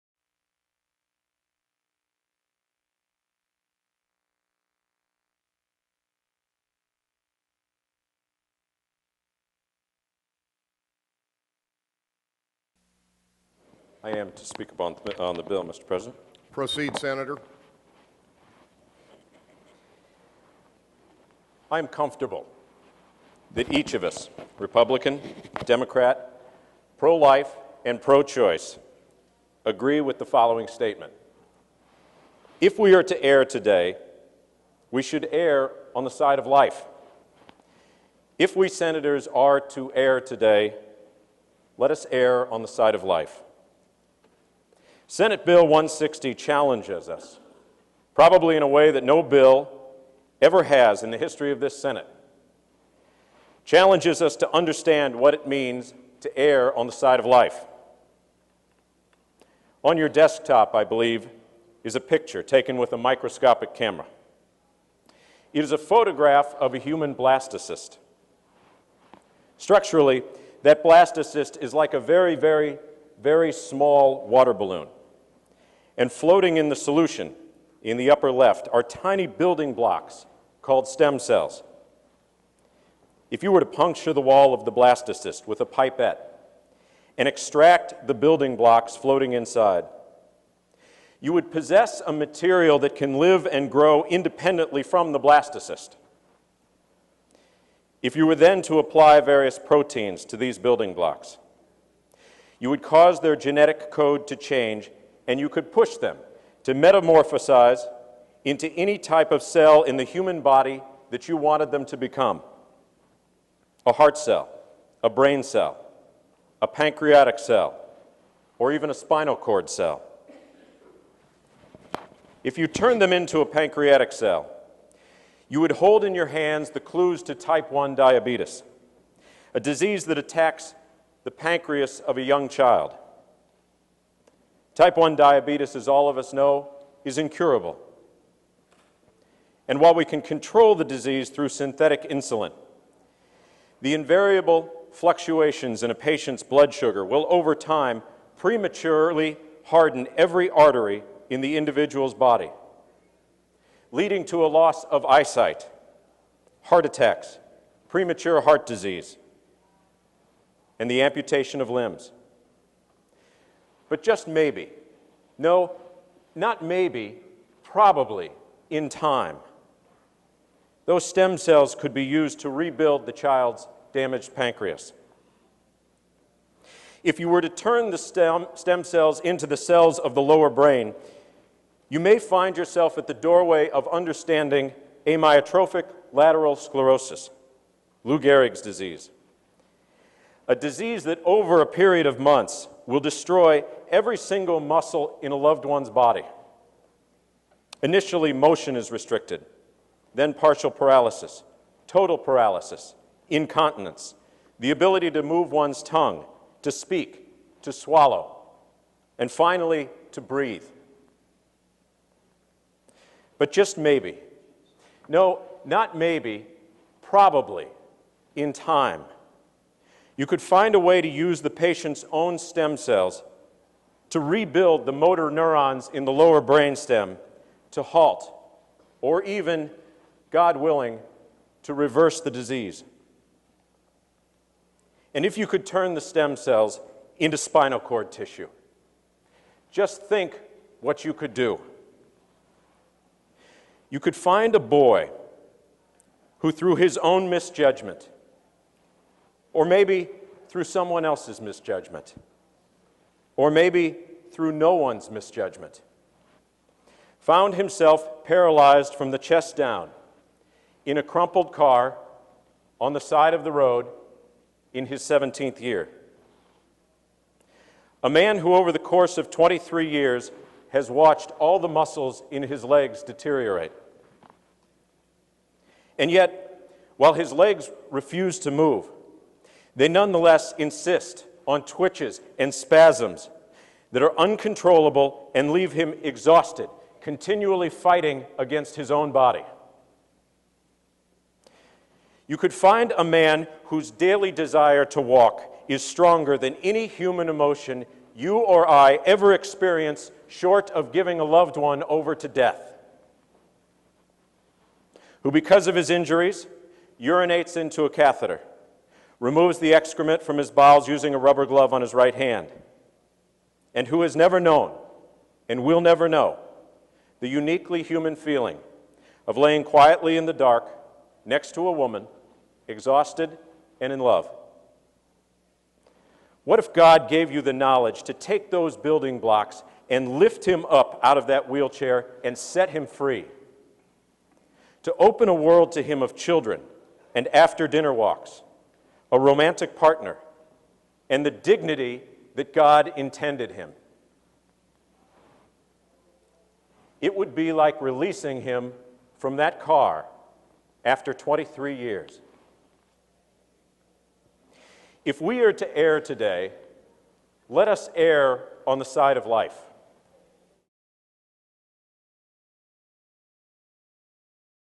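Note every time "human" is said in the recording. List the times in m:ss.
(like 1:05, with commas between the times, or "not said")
1:06, 1:50, 4:56, 5:17.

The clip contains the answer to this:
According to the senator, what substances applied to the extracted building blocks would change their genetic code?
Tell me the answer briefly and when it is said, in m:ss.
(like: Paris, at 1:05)
Proteins, at 1:39.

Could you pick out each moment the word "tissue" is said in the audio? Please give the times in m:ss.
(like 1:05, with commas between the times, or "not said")
3:58.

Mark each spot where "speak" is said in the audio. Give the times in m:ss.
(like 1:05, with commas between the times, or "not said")
0:14, 3:26.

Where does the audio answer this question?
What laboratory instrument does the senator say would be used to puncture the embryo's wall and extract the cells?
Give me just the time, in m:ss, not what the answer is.
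1:25.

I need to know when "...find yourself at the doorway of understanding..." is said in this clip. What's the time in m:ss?
3:02.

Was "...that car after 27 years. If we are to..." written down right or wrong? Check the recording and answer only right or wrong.
wrong.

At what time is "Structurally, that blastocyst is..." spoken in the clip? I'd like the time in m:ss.
1:09.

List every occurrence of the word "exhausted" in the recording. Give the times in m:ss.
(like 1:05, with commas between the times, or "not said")
4:46, 5:22.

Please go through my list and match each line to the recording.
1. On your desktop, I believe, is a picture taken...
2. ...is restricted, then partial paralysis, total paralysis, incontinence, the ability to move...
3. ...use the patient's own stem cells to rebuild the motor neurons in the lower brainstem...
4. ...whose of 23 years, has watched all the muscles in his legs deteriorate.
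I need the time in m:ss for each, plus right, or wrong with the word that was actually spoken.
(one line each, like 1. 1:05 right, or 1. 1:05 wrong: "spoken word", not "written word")
1. 0:59 right
2. 3:18 right
3. 3:41 right
4. 4:28 wrong: "course", not "whose".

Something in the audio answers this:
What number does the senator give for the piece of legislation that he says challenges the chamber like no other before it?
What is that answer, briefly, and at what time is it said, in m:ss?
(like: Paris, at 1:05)
160, at 0:45.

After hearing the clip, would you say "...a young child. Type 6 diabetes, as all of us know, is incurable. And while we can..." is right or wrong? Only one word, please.
wrong.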